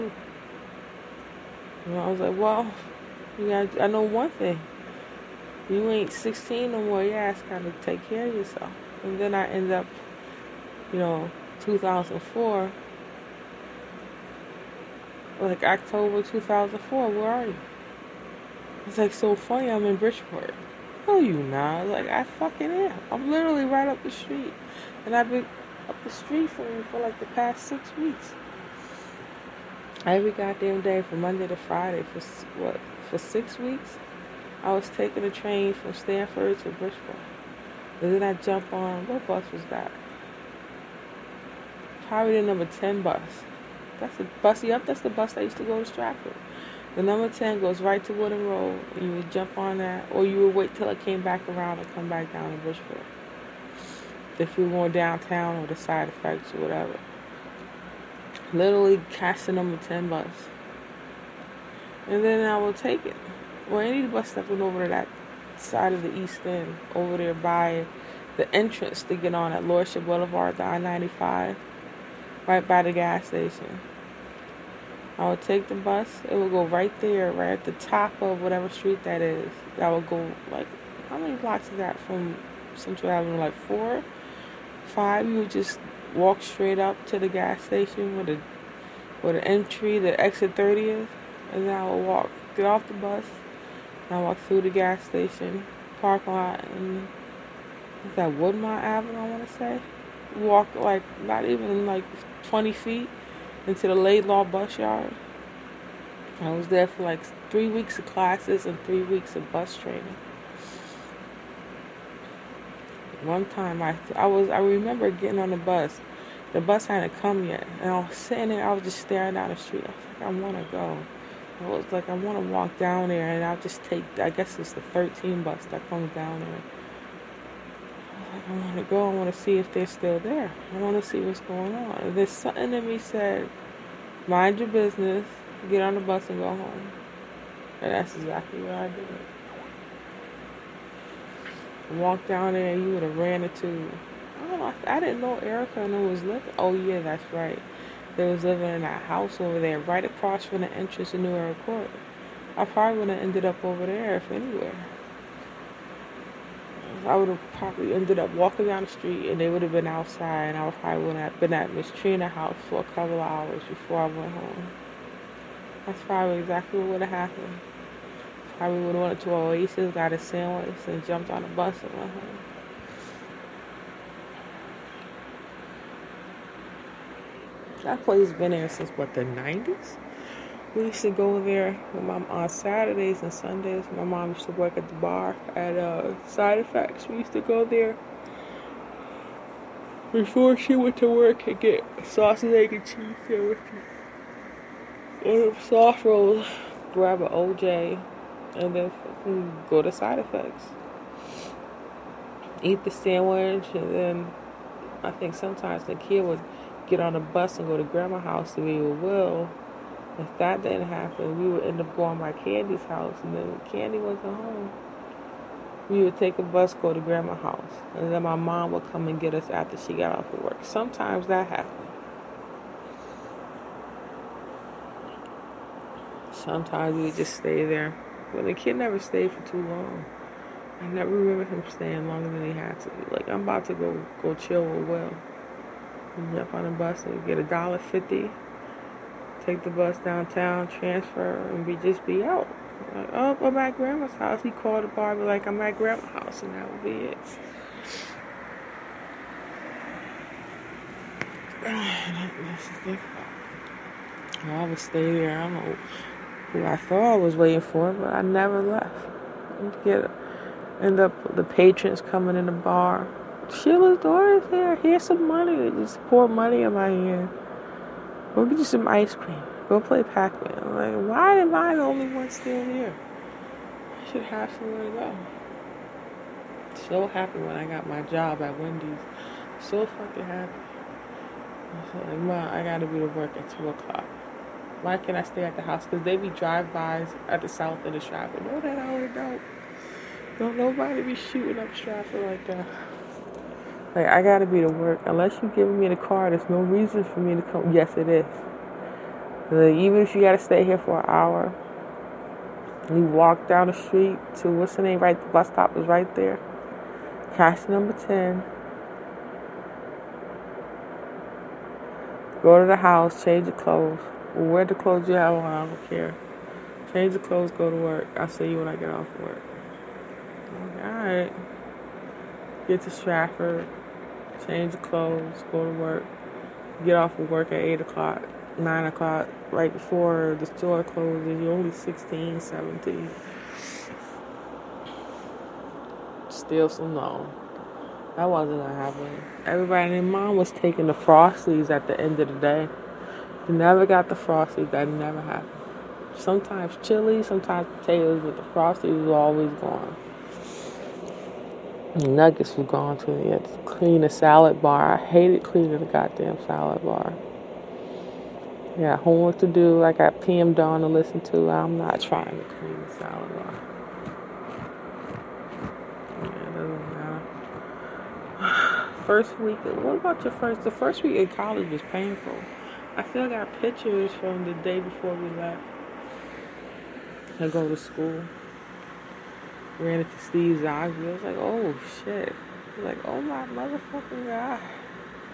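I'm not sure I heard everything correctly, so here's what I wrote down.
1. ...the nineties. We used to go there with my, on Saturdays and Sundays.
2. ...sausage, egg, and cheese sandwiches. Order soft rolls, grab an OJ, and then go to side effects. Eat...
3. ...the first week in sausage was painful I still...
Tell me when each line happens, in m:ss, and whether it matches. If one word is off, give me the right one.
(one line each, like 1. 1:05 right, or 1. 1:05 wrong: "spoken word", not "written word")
1. 2:59 right
2. 3:12 right
3. 6:10 wrong: "college", not "sausage".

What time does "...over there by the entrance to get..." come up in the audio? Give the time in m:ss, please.
1:06.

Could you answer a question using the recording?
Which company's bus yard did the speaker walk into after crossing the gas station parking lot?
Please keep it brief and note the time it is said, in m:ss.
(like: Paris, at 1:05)
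Laidlaw, at 1:43.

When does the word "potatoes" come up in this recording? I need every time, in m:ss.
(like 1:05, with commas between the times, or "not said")
5:47.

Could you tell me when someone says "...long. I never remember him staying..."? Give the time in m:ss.
3:49.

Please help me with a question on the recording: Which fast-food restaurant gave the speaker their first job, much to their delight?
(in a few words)
Wendy's.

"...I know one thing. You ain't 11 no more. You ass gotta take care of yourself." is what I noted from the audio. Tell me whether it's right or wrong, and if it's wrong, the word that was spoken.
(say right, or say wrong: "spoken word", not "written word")
wrong: "16", not "11".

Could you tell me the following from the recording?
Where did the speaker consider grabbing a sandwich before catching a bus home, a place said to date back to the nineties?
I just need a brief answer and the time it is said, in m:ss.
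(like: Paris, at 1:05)
Oasis, at 2:49.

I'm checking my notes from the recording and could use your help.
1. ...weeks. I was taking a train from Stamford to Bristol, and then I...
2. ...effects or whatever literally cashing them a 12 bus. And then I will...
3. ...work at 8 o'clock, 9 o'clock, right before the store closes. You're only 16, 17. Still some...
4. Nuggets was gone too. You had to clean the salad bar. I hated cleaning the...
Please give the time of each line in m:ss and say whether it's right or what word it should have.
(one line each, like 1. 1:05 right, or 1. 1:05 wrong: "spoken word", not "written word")
1. 0:33 right
2. 0:56 wrong: "10", not "12"
3. 5:27 right
4. 5:52 right.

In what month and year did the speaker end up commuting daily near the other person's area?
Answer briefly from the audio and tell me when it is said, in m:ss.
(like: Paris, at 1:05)
October 2004, at 0:15.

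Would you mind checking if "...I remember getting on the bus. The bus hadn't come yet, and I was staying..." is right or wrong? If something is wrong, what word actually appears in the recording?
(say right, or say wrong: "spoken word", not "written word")
wrong: "sitting", not "staying".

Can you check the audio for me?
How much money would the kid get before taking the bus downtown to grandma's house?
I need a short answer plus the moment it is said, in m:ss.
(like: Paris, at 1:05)
$1.50, at 3:57.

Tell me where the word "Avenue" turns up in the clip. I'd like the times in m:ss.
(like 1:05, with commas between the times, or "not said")
1:23, 1:38.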